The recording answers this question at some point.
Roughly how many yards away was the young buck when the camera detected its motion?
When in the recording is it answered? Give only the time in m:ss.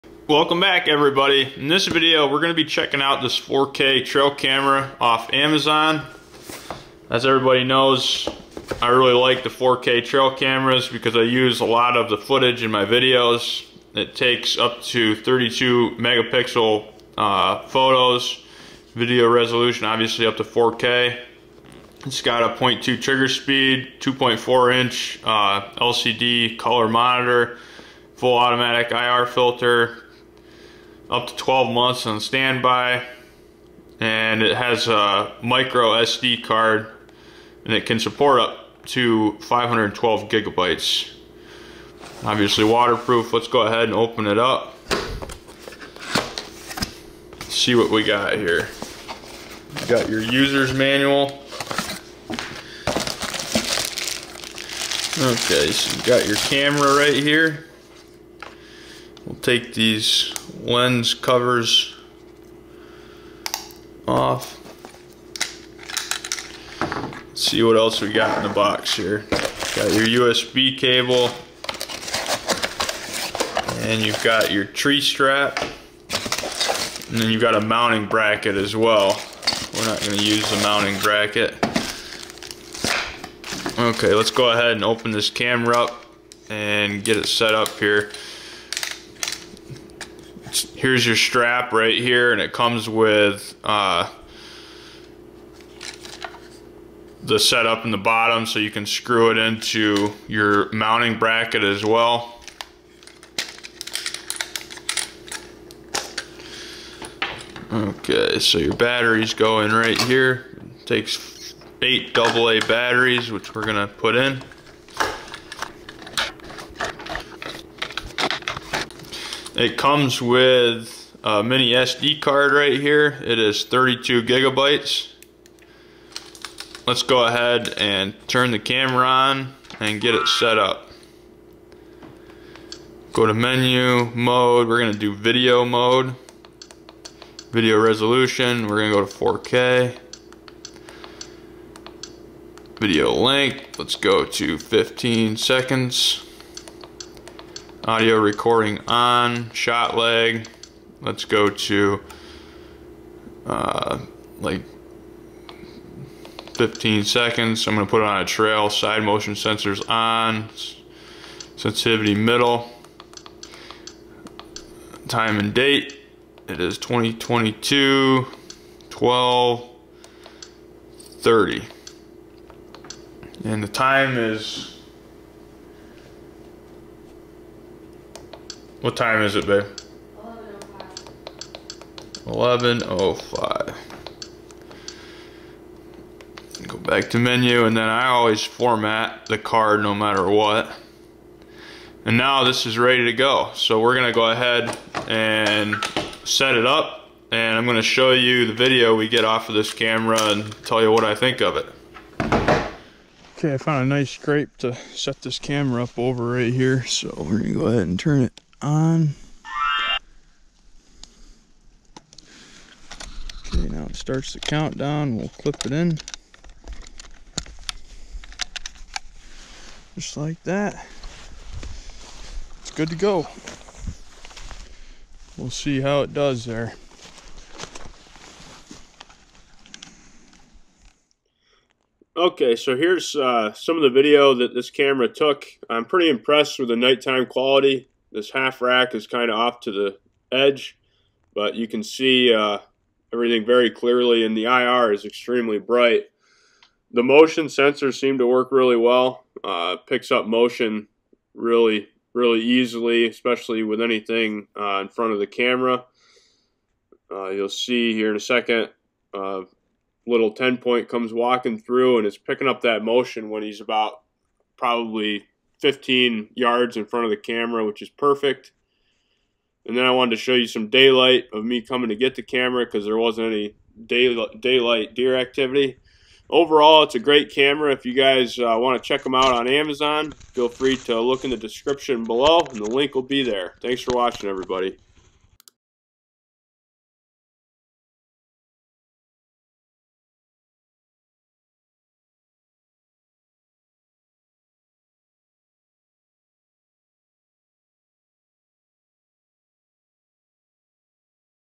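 4:25.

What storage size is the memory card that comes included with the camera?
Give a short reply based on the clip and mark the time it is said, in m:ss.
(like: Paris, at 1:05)
32 gigabytes, at 2:03.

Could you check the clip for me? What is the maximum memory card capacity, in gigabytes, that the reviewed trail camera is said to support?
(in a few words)
512.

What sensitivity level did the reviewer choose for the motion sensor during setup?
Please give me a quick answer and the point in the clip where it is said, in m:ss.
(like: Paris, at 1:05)
Middle, at 2:42.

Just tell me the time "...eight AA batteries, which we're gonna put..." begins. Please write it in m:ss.
1:51.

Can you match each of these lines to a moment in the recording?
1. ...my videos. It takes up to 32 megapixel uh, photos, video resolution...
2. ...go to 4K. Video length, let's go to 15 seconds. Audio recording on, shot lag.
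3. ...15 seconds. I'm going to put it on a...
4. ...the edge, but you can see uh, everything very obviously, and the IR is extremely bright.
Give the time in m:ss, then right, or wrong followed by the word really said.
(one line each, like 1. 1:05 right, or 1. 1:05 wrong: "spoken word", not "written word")
1. 0:12 right
2. 2:18 right
3. 2:36 right
4. 3:59 wrong: "clearly", not "obviously".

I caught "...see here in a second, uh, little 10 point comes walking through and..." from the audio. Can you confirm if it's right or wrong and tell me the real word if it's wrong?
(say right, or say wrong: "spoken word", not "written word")
right.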